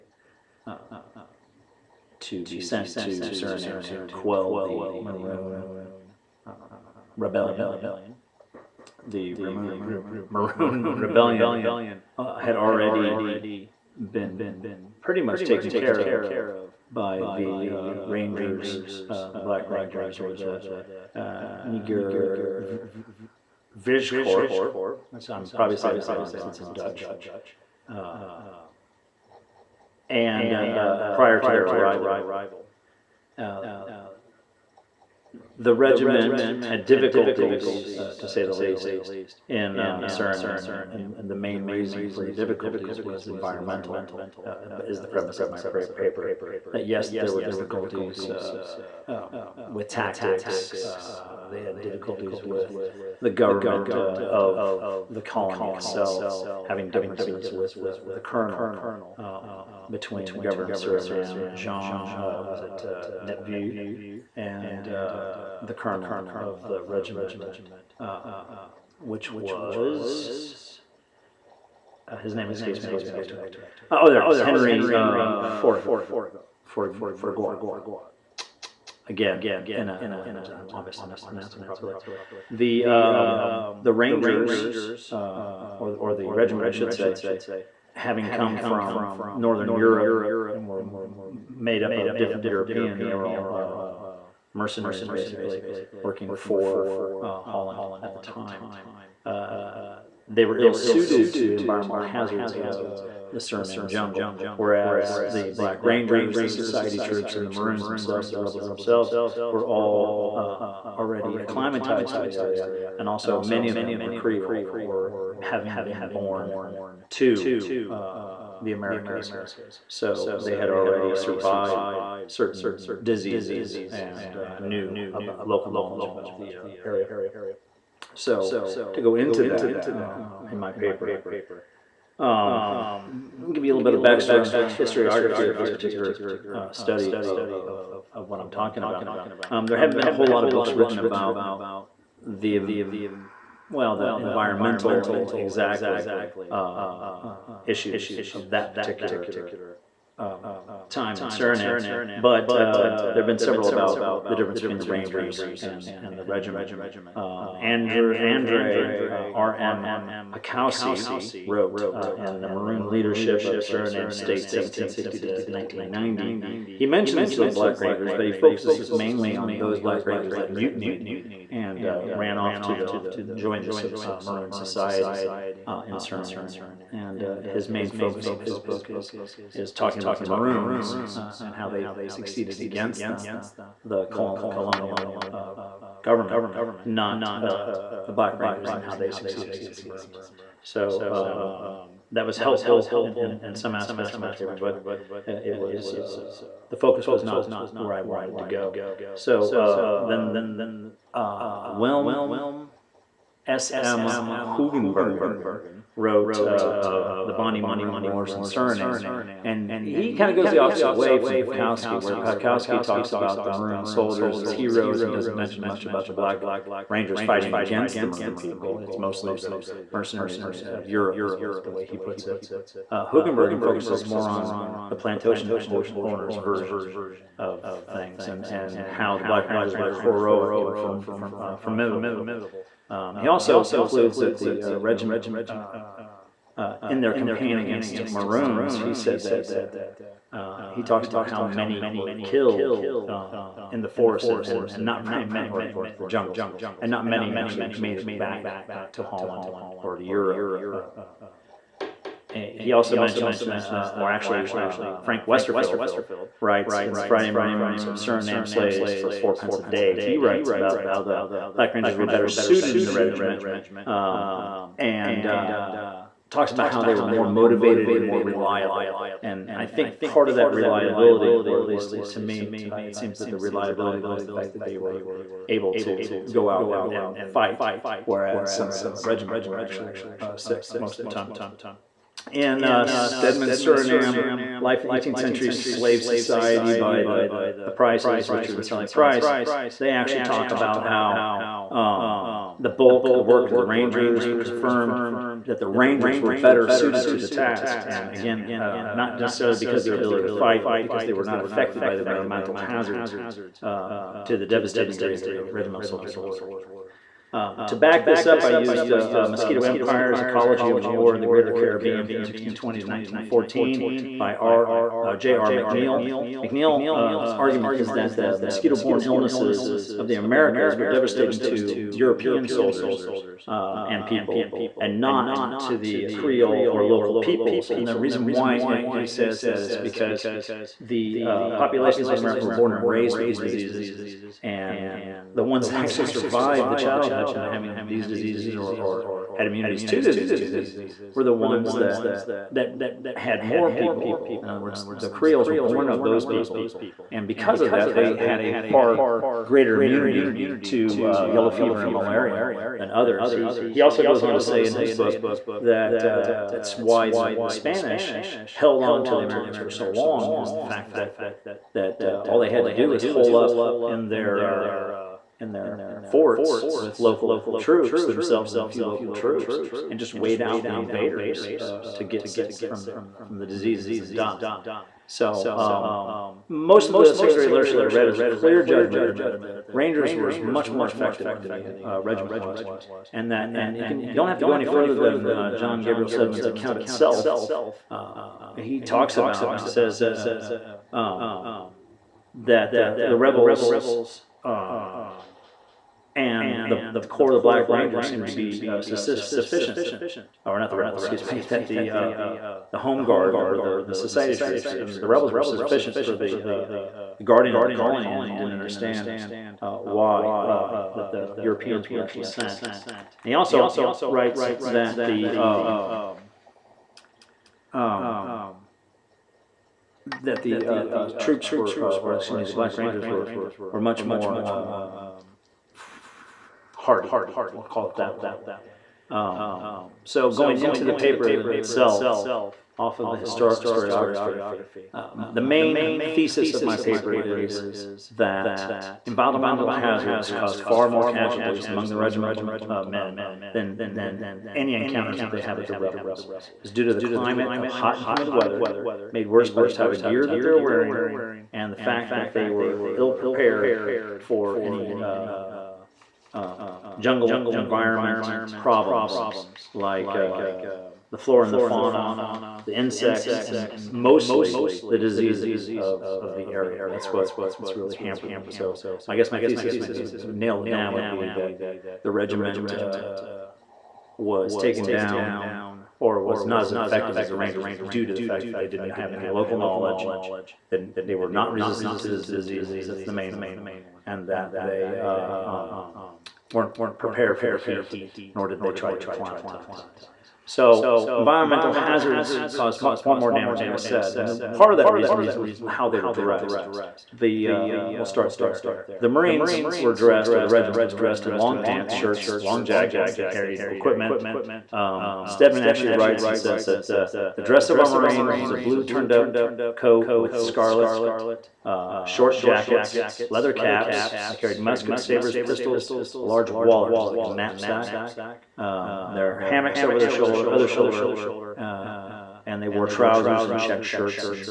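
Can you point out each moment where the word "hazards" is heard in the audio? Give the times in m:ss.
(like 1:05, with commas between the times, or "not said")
1:42, 5:02, 7:19, 8:11.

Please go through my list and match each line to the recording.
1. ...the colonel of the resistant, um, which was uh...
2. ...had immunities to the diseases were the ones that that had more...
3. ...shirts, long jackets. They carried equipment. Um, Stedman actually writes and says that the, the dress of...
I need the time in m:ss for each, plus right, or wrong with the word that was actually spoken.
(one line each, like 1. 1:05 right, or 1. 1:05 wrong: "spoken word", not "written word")
1. 1:05 wrong: "regiment", not "resistant"
2. 5:39 right
3. 8:21 right.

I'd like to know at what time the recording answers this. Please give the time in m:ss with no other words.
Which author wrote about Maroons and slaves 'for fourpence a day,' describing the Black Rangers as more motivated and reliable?
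4:15.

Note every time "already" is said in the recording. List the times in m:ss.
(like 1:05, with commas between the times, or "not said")
0:12, 1:50, 2:00.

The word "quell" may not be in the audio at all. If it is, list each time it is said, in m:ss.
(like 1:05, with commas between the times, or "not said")
0:04.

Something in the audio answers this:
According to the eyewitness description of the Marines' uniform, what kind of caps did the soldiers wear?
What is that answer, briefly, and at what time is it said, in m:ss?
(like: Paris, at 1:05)
Leather caps, at 8:33.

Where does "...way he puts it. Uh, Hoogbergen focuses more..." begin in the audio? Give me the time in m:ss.
3:41.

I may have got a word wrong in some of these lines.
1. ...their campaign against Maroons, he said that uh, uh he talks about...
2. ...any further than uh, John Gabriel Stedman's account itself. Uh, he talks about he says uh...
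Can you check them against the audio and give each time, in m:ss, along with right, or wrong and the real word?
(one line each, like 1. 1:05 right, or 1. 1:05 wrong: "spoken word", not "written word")
1. 3:57 right
2. 6:24 right.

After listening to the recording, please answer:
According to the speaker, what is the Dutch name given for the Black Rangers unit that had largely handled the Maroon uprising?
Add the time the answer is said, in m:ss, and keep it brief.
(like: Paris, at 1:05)
Niger Vijkorp, at 0:21.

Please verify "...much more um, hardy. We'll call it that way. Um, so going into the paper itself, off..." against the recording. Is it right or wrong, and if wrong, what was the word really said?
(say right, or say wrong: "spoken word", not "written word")
right.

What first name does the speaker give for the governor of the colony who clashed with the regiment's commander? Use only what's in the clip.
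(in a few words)
Jean.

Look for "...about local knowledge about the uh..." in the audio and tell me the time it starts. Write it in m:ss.
2:05.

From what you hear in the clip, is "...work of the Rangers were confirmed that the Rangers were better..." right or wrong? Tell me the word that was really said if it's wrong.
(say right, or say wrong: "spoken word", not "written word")
right.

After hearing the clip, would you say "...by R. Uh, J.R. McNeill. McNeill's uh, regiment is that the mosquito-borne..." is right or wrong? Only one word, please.
wrong.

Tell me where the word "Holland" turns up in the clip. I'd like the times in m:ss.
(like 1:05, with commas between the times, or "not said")
1:37, 4:09.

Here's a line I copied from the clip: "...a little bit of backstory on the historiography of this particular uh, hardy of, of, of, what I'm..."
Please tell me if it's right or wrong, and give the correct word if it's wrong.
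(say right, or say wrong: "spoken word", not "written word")
wrong: "study", not "hardy".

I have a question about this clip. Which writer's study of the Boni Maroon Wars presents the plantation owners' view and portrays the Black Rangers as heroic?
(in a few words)
Wim S.M. Hoogbergen.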